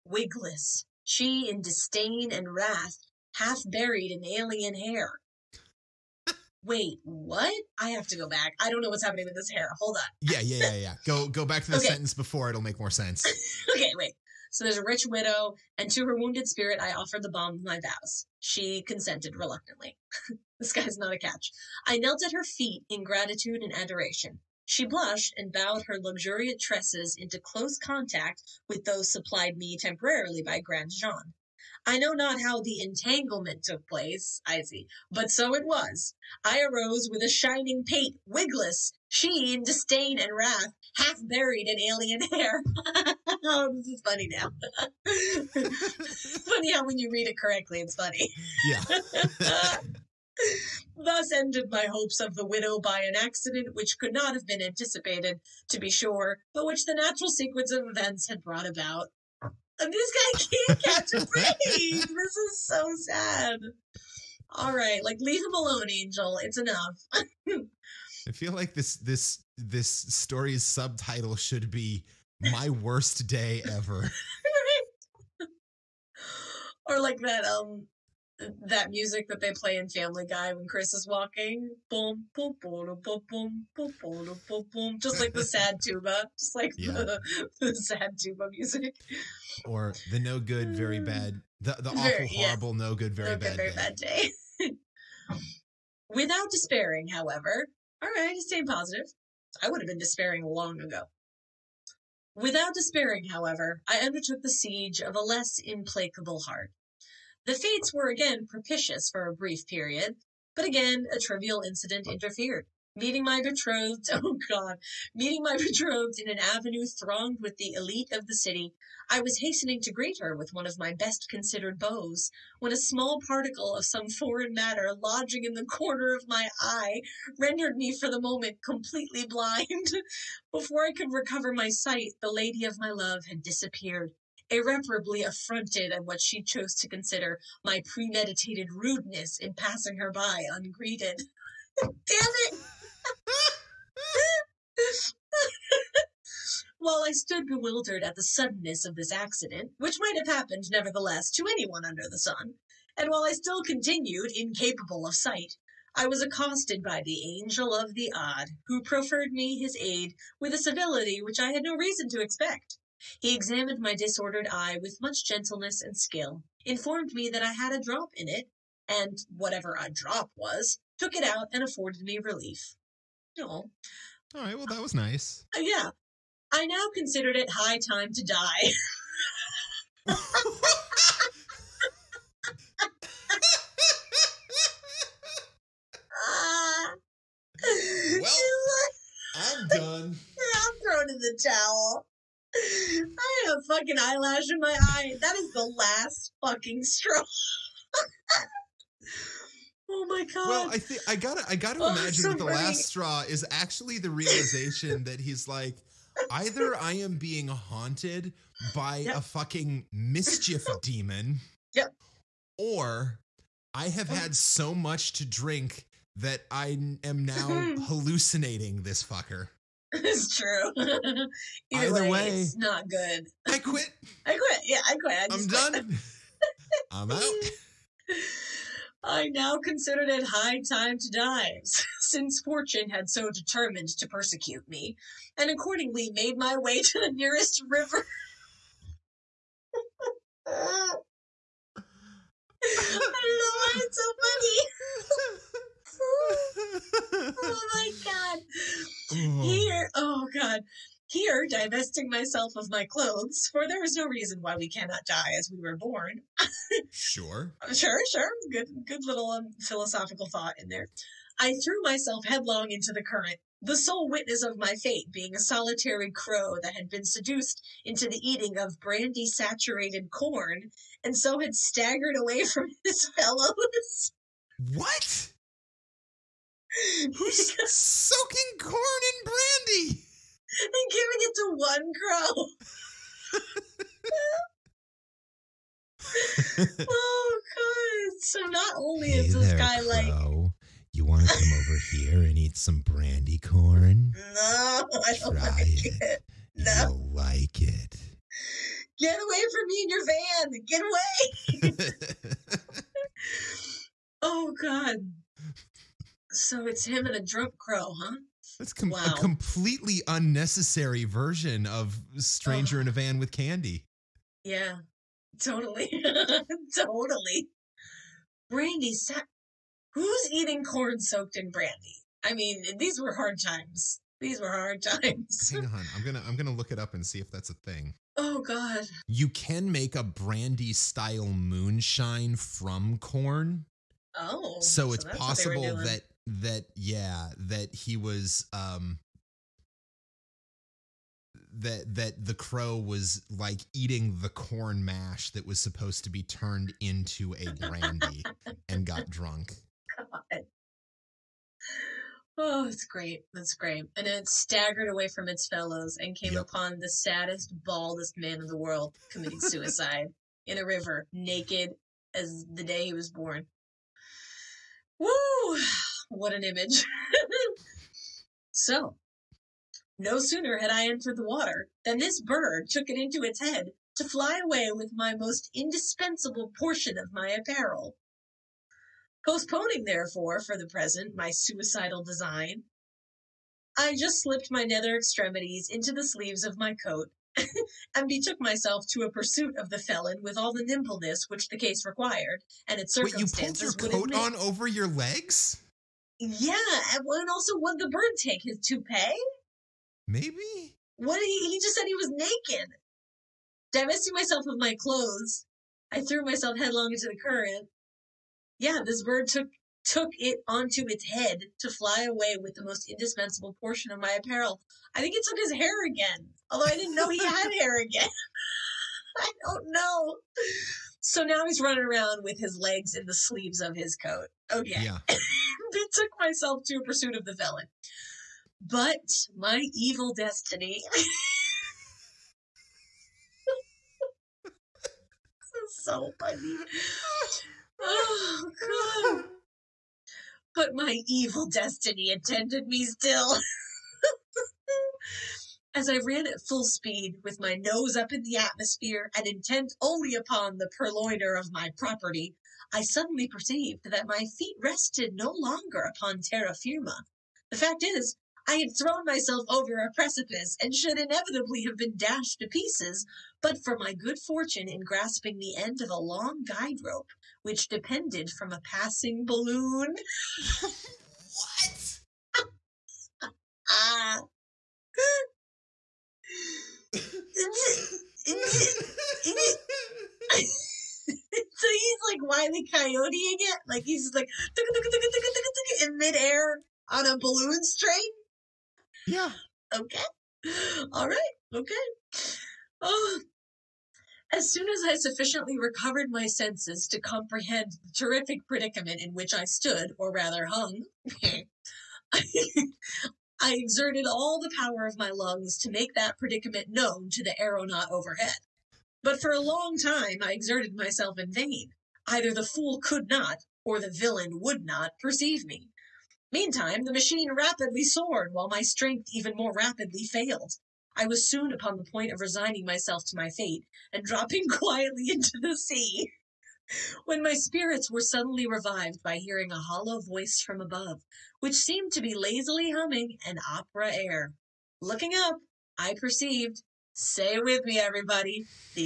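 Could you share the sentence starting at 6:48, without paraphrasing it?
Yeah, this bird took took it onto its head to fly away with the most indispensable portion of my apparel.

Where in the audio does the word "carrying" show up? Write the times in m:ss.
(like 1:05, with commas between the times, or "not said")
not said.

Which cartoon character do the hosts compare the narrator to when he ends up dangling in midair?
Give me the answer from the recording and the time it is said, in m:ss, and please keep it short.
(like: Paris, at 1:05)
Wiley Coyote, at 8:02.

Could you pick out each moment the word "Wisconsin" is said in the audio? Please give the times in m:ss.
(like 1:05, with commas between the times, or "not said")
not said.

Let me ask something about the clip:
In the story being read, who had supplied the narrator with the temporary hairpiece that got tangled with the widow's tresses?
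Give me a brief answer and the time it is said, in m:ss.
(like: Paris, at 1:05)
Grandjean, at 0:30.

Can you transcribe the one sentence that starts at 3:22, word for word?
last straw is actually the realization that he's like, either I am being haunted by yep.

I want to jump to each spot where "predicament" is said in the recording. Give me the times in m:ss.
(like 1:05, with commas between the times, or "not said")
8:18, 8:26.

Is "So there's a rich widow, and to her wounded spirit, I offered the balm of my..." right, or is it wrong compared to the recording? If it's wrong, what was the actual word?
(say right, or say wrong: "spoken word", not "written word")
right.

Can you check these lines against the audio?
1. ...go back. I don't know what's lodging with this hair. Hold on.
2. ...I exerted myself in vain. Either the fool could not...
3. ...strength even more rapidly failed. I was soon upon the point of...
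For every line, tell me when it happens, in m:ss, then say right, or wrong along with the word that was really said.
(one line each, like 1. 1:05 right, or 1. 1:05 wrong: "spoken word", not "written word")
1. 0:08 wrong: "happening", not "lodging"
2. 8:30 right
3. 8:38 right.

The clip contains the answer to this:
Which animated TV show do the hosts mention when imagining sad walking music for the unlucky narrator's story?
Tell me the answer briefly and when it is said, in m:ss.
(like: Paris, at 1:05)
Family Guy, at 1:19.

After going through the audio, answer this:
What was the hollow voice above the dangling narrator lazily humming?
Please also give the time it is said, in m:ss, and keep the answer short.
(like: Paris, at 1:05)
an opera air, at 8:53.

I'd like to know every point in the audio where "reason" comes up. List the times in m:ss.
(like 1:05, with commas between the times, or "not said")
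2:41, 4:14.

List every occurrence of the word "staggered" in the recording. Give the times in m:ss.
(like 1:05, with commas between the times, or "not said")
4:31, 5:54.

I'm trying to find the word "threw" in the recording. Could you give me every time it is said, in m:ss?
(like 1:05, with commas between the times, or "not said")
4:21, 6:46.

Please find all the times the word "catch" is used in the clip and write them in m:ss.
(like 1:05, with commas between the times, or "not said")
0:21, 1:00.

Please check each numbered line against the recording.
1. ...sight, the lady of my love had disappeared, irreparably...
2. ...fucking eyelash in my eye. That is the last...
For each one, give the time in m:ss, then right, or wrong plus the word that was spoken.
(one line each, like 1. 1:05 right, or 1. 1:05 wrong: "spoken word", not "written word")
1. 2:11 right
2. 3:13 right.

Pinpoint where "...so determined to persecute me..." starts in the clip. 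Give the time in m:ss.
3:53.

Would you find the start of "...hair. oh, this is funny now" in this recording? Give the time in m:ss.
0:42.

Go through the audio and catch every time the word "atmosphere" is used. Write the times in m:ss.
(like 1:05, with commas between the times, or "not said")
7:28.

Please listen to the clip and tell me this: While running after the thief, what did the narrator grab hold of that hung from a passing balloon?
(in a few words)
a long guide rope.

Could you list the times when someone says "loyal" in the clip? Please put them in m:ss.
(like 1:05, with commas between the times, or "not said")
not said.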